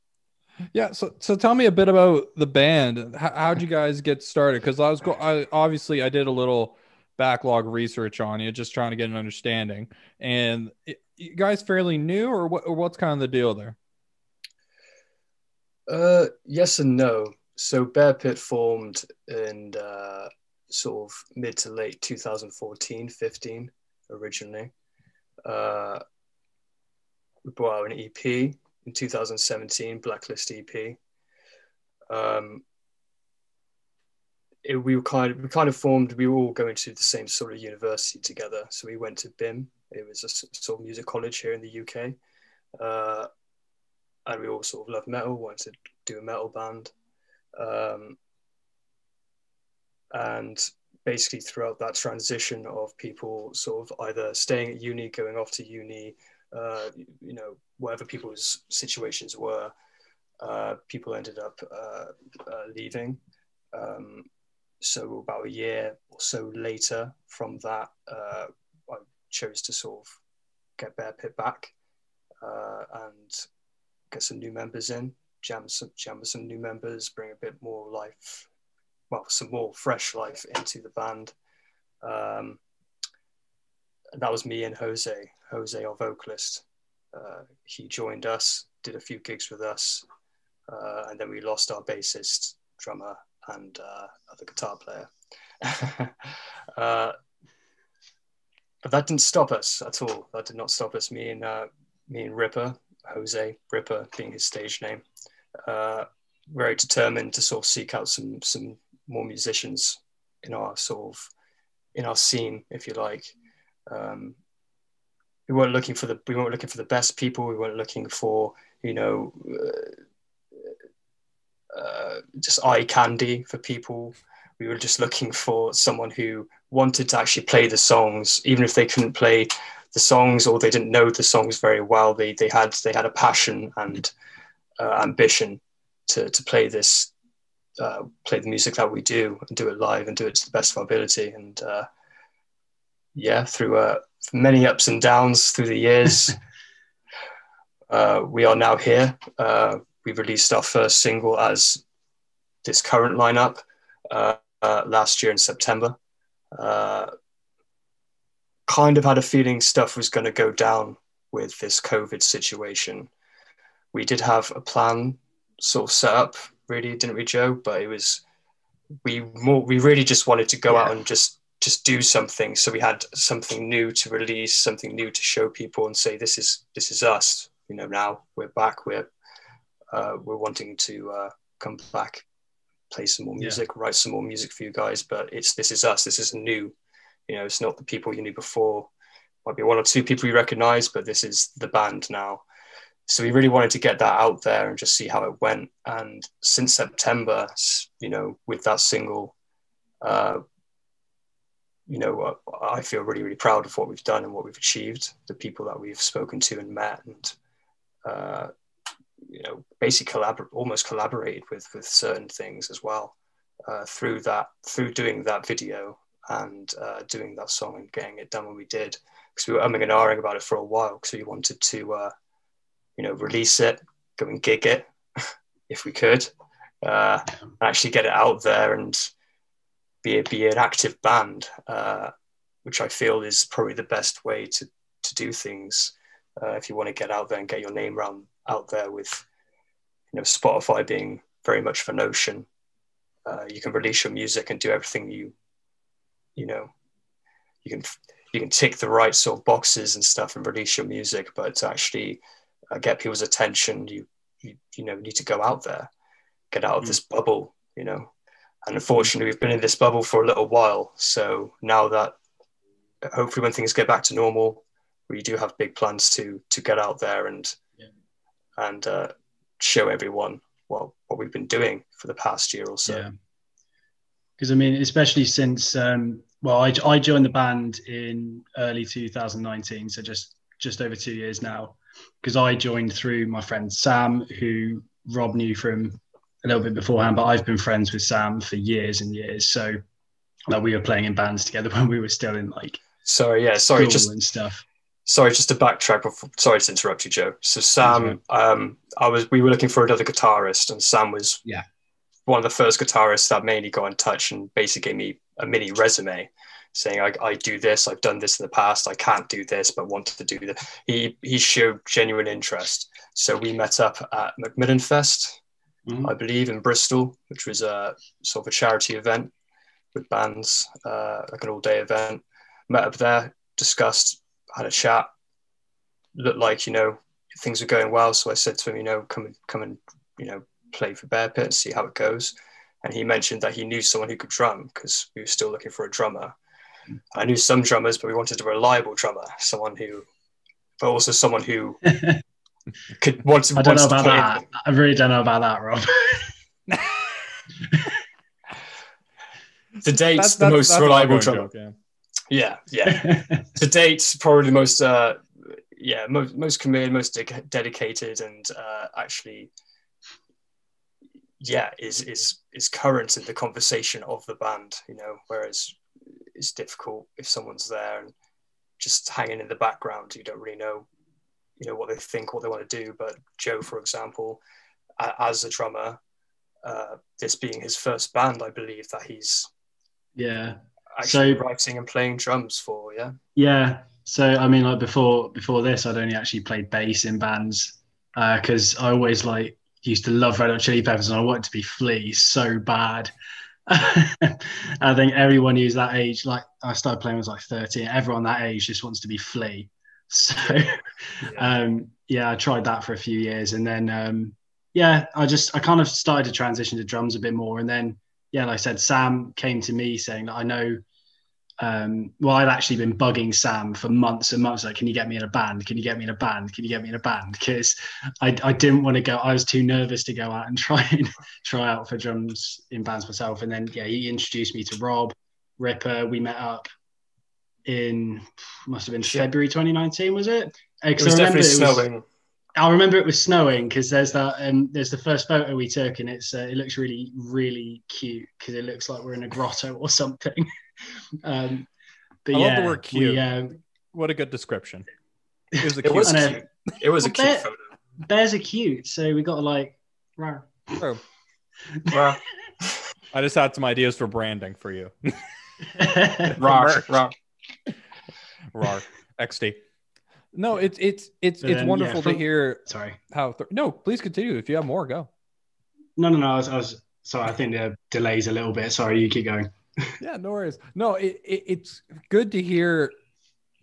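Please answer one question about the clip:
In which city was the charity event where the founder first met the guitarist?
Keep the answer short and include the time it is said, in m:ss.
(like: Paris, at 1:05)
Bristol, at 5:16.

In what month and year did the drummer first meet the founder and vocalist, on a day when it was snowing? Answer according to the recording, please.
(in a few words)
February 2019.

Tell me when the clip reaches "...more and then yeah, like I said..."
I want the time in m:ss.
6:47.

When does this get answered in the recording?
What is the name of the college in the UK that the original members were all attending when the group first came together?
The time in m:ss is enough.
0:39.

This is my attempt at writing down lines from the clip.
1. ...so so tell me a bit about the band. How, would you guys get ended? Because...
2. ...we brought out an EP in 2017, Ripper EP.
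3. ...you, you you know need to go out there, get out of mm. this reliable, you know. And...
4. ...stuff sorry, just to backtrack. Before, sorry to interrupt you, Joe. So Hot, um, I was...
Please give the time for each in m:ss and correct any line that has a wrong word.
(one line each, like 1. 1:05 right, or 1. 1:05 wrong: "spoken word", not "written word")
1. 0:00 wrong: "started", not "ended"
2. 0:27 wrong: "Blacklist", not "Ripper"
3. 4:13 wrong: "bubble", not "reliable"
4. 4:54 wrong: "Sam", not "Hot".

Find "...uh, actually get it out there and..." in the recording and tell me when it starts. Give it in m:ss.
3:46.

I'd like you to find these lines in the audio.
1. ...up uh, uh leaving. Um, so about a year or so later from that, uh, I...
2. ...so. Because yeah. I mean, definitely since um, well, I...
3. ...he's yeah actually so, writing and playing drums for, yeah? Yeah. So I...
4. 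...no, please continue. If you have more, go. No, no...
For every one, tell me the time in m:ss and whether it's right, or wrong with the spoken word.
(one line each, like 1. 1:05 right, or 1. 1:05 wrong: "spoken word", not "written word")
1. 1:01 right
2. 4:32 wrong: "especially", not "definitely"
3. 6:19 right
4. 7:43 right.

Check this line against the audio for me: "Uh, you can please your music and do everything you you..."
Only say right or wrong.
wrong.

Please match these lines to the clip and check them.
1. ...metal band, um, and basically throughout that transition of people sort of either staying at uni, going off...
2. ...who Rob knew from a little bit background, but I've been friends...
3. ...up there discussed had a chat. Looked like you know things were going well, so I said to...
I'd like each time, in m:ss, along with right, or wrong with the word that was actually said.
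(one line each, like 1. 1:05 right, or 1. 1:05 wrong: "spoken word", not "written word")
1. 0:46 right
2. 4:44 wrong: "beforehand", not "background"
3. 5:22 right.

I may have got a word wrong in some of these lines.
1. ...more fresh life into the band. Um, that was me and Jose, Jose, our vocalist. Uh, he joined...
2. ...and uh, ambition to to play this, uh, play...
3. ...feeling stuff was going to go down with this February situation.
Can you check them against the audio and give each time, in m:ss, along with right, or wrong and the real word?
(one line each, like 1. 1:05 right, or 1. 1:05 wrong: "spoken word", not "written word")
1. 1:19 right
2. 2:13 right
3. 2:39 wrong: "COVID", not "February".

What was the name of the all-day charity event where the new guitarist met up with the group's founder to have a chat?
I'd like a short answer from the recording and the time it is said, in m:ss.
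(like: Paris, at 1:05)
MacMillan Fest, at 5:14.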